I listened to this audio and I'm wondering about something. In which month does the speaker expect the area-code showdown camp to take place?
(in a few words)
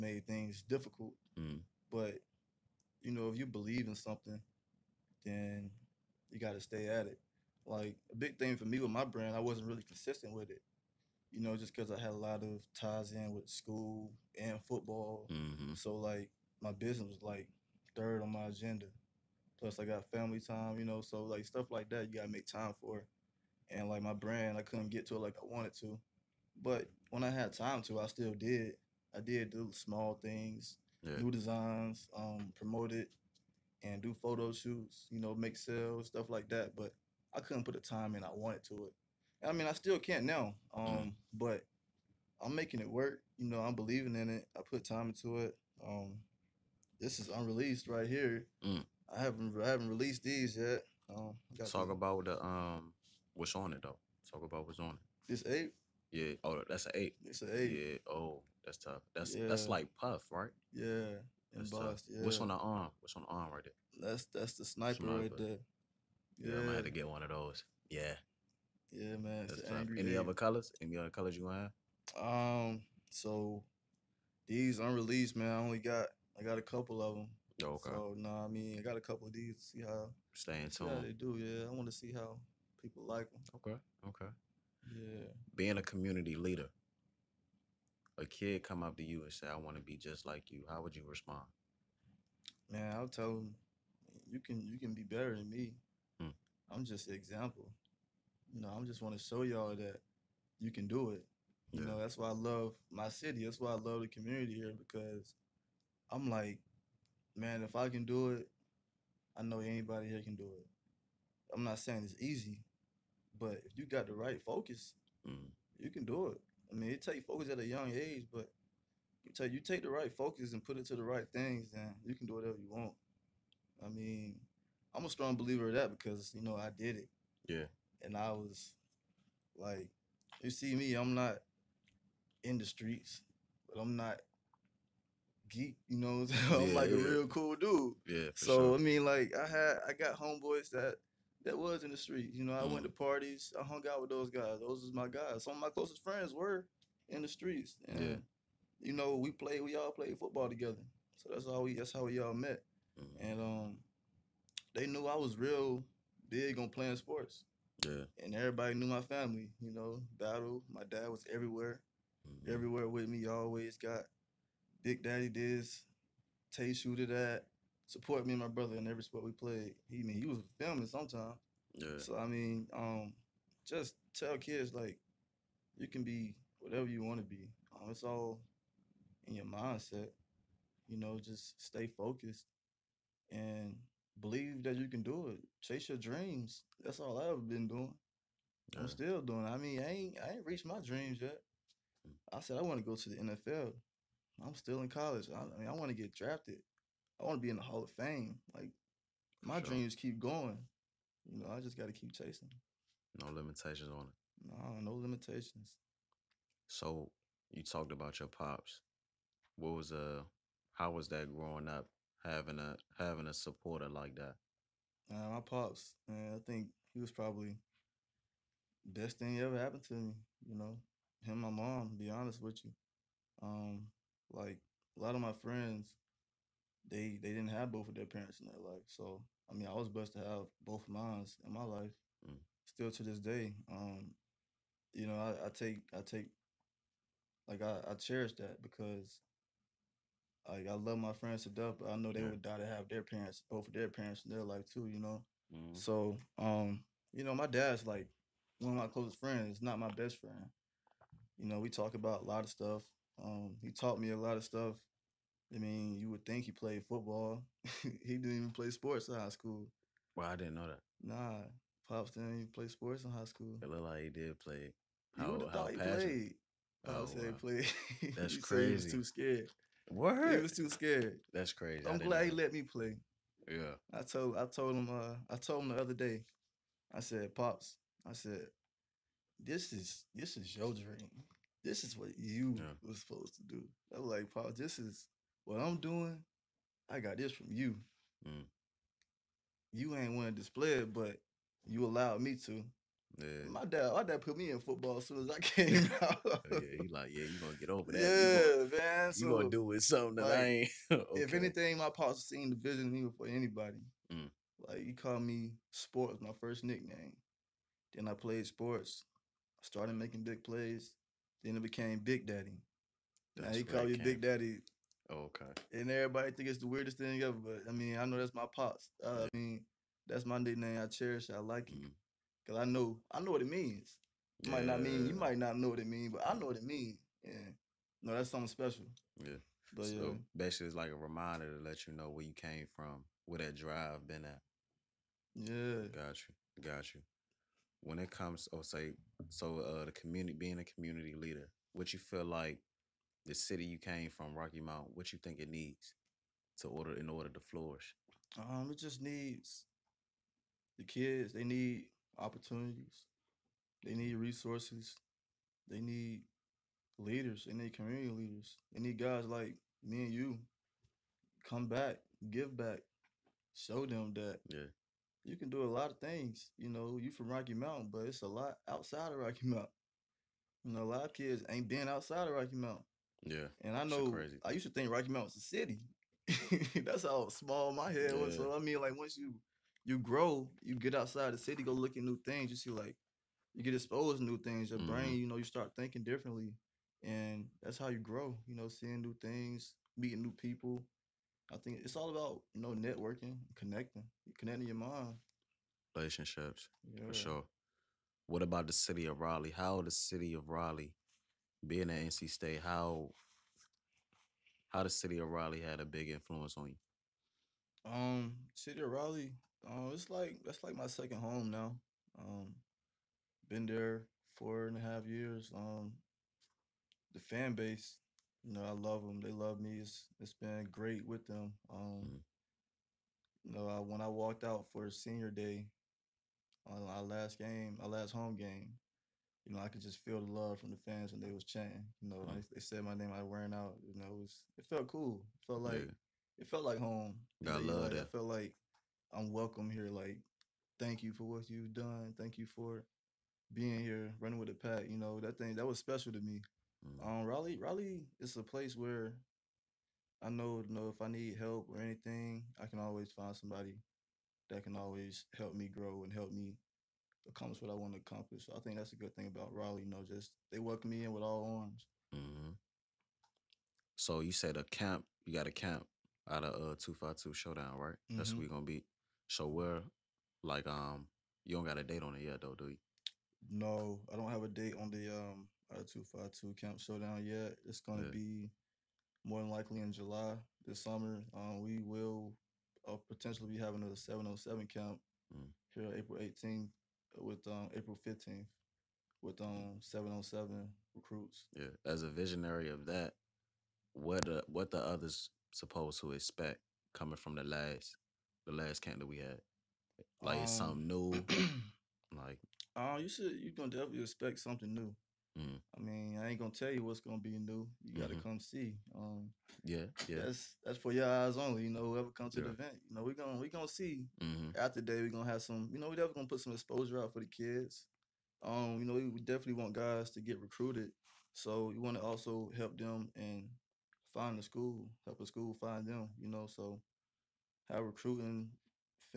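July.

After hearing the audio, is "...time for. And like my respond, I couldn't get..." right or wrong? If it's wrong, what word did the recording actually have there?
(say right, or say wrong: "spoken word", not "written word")
wrong: "brand", not "respond".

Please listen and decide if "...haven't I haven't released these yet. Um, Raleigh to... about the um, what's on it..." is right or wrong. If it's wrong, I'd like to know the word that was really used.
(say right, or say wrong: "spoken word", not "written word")
wrong: "Talk", not "Raleigh".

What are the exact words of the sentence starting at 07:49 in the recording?
So we're like um you don't got a date on it yet though, do you?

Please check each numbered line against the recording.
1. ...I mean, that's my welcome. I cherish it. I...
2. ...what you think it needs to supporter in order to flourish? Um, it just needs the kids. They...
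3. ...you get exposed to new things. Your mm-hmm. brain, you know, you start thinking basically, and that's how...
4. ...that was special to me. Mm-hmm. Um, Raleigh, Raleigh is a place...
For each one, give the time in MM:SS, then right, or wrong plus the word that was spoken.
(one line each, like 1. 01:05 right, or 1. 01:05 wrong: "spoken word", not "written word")
1. 05:19 wrong: "nickname", not "welcome"
2. 05:44 wrong: "order", not "supporter"
3. 06:23 wrong: "differently", not "basically"
4. 07:25 right.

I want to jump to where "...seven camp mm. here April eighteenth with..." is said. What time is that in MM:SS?
08:04.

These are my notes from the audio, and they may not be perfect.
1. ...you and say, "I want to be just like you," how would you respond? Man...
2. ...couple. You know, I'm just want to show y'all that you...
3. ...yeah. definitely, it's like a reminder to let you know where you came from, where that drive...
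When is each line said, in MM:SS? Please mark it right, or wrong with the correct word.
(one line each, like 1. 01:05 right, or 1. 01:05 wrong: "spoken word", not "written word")
1. 01:29 right
2. 01:37 wrong: "example", not "couple"
3. 05:29 wrong: "basically", not "definitely".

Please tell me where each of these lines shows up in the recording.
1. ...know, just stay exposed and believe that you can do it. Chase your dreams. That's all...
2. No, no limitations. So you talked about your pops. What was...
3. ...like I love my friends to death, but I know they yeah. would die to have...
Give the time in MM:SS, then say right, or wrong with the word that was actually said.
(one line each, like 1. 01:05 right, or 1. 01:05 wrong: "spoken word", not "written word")
1. 03:00 wrong: "focused", not "exposed"
2. 03:24 right
3. 04:00 right.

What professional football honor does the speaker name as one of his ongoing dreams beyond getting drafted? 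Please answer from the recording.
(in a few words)
Hall of Fame.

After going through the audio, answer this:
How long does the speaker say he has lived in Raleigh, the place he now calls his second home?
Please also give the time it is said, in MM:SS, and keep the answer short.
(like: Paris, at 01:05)
4 and a half years, at 06:54.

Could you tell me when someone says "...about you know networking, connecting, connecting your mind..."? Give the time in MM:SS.
06:32.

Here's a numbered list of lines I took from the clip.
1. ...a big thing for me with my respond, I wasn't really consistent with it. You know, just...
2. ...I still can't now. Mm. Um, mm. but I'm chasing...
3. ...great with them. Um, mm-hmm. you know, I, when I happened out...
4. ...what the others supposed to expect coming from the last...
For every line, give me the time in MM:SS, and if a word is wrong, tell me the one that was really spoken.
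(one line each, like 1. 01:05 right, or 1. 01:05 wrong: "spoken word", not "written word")
1. 00:08 wrong: "brand", not "respond"
2. 00:39 wrong: "making", not "chasing"
3. 07:00 wrong: "walked", not "happened"
4. 08:14 right.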